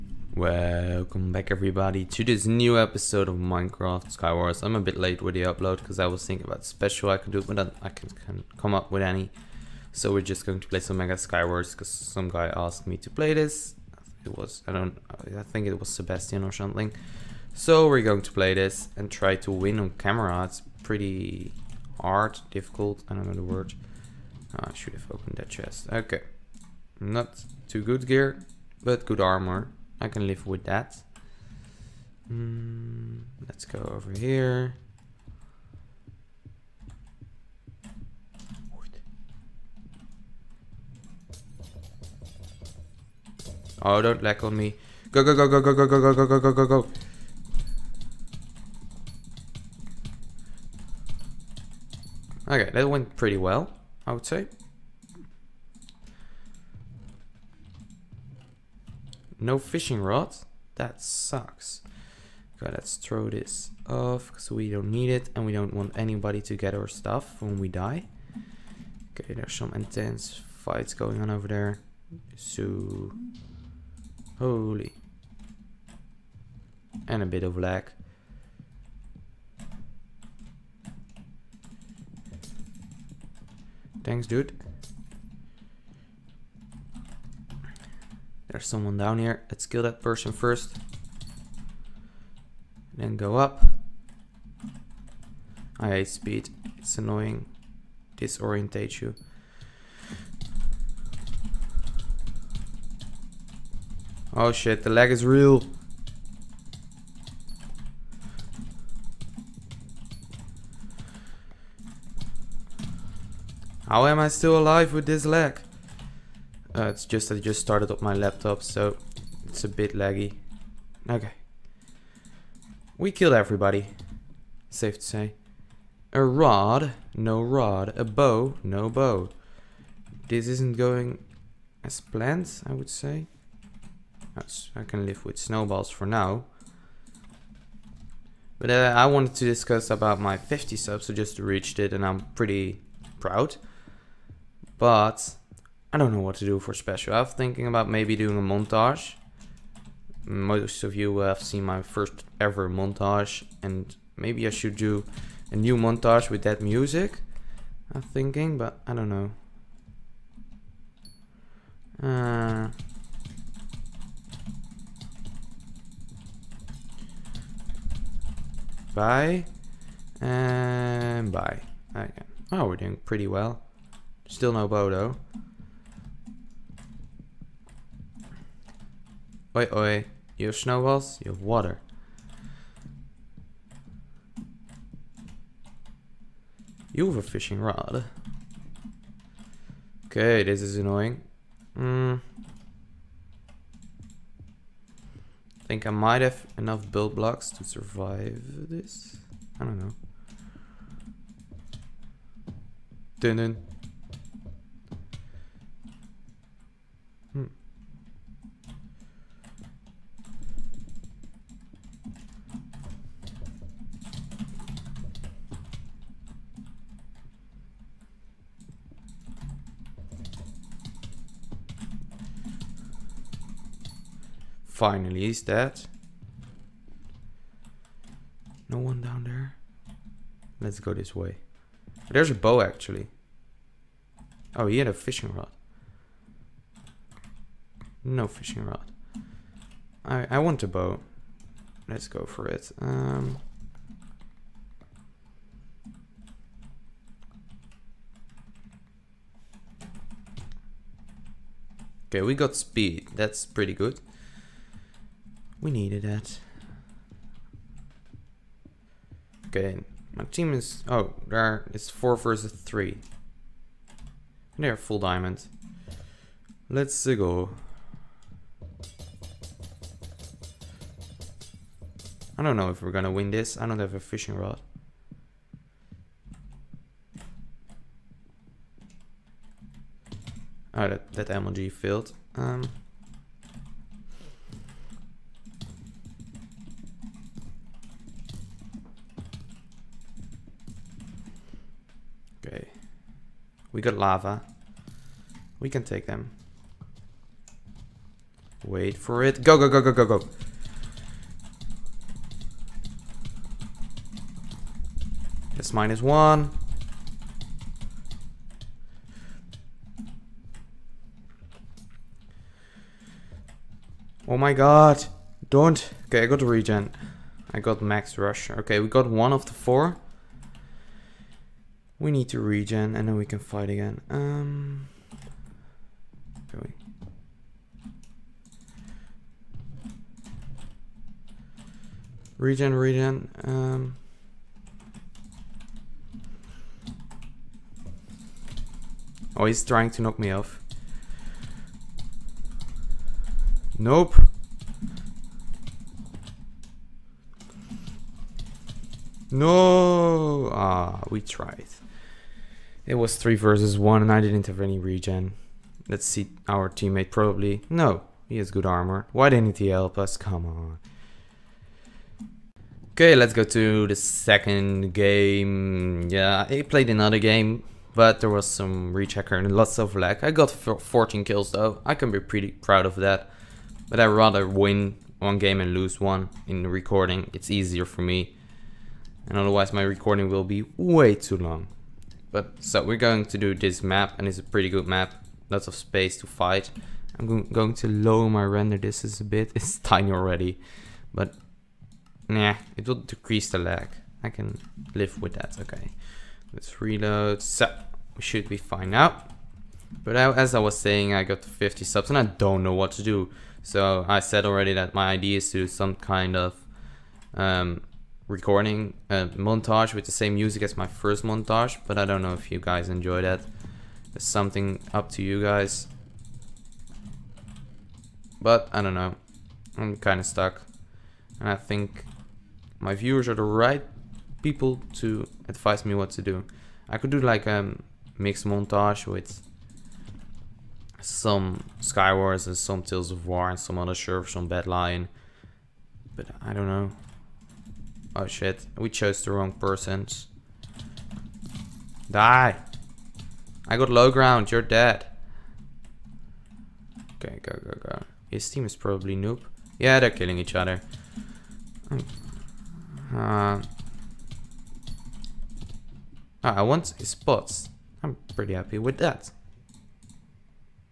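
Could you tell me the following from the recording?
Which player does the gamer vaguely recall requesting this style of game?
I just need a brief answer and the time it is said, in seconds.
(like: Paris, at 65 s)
Sebastian, at 15 s.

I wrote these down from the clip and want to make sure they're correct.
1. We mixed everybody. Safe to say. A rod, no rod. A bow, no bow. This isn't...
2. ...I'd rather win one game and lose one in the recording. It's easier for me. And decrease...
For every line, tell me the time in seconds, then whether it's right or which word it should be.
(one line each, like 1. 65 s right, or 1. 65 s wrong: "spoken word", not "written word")
1. 122 s wrong: "killed", not "mixed"
2. 373 s wrong: "otherwise", not "decrease".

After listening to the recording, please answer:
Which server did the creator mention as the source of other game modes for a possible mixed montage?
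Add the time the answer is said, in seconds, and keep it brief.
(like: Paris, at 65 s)
Badlion, at 434 s.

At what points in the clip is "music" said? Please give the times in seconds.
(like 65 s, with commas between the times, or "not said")
156 s, 410 s.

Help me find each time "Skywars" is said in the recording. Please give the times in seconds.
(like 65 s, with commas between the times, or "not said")
4 s, 11 s, 431 s.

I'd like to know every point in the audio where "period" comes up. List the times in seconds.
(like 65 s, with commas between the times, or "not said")
not said.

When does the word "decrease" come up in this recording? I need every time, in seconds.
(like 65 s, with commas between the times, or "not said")
393 s.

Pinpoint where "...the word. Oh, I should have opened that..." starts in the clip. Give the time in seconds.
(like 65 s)
23 s.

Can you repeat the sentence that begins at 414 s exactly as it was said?
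It's something up to you guys.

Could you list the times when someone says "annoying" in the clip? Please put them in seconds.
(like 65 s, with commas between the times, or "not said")
96 s, 190 s.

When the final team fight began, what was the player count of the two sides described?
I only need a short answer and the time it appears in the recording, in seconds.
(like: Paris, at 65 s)
4 versus 3, at 261 s.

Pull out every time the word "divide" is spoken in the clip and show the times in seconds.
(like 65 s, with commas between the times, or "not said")
not said.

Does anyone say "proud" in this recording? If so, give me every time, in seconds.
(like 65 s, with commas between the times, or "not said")
143 s, 372 s.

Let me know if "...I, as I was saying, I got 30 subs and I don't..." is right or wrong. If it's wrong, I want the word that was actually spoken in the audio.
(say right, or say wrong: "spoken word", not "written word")
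wrong: "50", not "30".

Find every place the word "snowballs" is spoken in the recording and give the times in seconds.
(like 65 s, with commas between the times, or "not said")
135 s, 180 s.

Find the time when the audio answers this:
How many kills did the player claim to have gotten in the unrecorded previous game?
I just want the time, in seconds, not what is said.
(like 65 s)
370 s.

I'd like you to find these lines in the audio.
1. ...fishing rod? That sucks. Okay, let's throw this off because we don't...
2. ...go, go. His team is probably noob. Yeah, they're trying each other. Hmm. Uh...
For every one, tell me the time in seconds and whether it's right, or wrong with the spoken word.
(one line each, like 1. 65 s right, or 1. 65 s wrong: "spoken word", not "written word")
1. 59 s right
2. 447 s wrong: "killing", not "trying".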